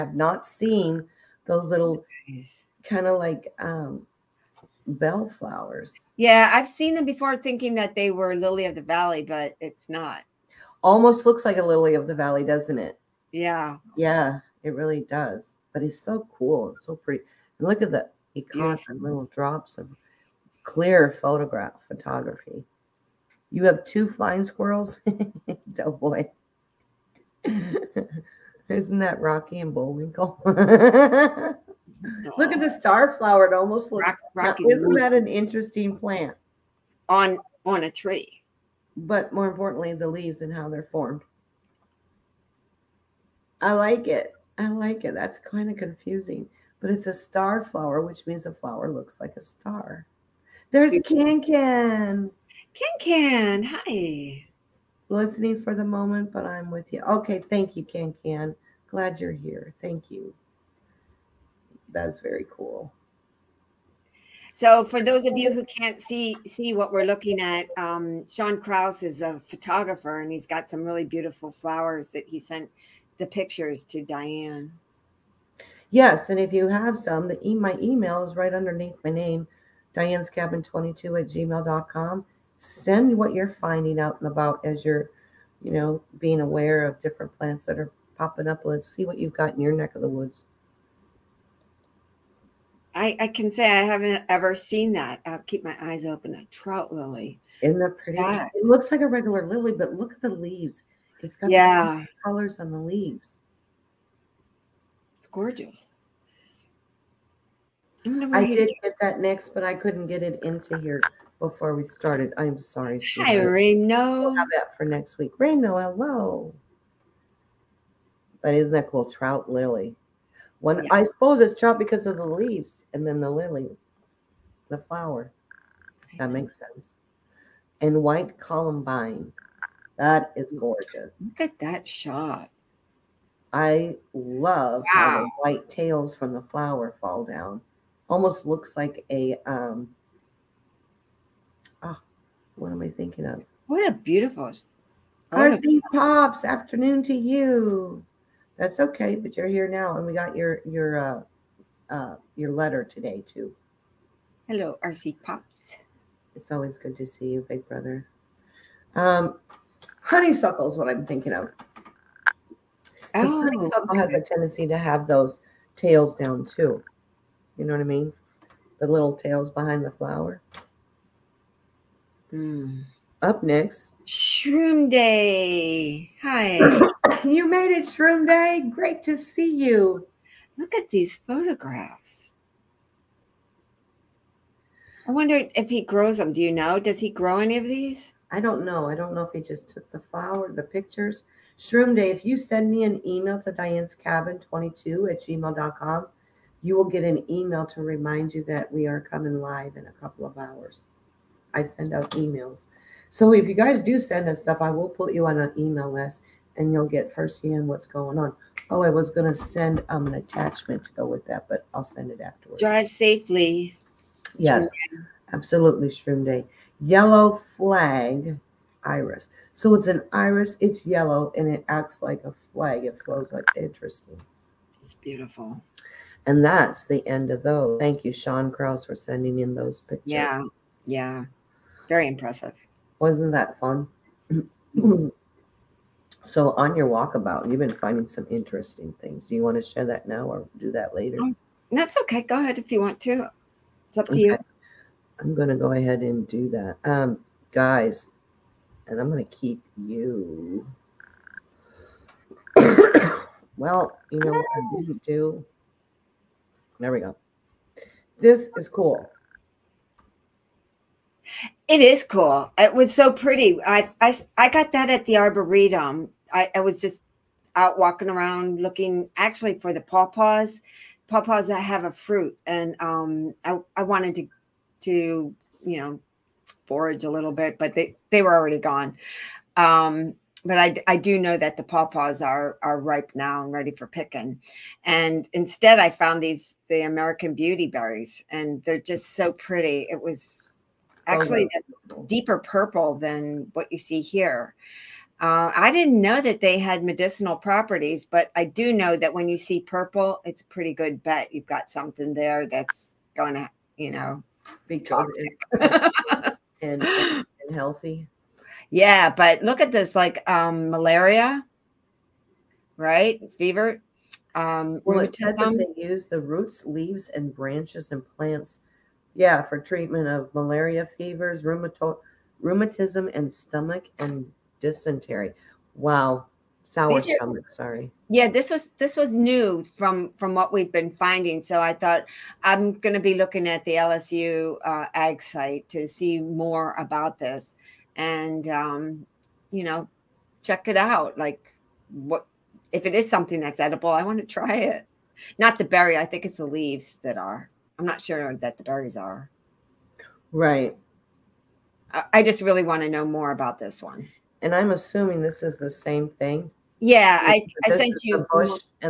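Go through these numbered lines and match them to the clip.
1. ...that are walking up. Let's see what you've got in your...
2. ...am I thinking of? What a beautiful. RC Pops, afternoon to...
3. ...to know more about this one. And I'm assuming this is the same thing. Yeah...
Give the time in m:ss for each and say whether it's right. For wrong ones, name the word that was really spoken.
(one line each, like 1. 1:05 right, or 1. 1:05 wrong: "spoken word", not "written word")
1. 1:27 wrong: "popping", not "walking"
2. 2:22 right
3. 5:52 right.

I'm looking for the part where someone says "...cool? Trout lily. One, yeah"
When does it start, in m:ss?
1:58.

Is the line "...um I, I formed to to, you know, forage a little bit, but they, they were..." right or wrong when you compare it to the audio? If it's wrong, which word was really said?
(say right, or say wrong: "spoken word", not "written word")
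wrong: "wanted", not "formed".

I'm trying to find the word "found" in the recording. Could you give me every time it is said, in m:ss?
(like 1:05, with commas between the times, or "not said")
4:45.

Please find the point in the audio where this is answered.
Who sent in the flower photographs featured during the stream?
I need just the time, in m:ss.
1:08.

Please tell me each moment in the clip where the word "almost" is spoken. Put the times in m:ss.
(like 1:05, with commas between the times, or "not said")
0:10, 0:33, 2:18.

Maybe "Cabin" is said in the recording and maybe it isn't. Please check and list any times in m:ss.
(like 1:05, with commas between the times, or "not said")
1:20, 3:13.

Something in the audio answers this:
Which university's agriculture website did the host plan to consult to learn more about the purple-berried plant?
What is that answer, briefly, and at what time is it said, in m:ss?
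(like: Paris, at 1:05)
LSU, at 5:33.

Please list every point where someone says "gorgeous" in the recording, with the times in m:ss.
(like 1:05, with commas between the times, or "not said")
1:45, 2:10.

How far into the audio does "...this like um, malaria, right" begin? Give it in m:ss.
5:09.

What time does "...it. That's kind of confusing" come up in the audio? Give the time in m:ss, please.
0:45.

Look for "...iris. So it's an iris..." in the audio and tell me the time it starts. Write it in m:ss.
3:38.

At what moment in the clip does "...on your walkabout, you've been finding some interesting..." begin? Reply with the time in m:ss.
3:56.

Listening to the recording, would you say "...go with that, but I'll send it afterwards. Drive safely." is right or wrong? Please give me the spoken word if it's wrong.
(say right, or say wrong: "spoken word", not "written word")
right.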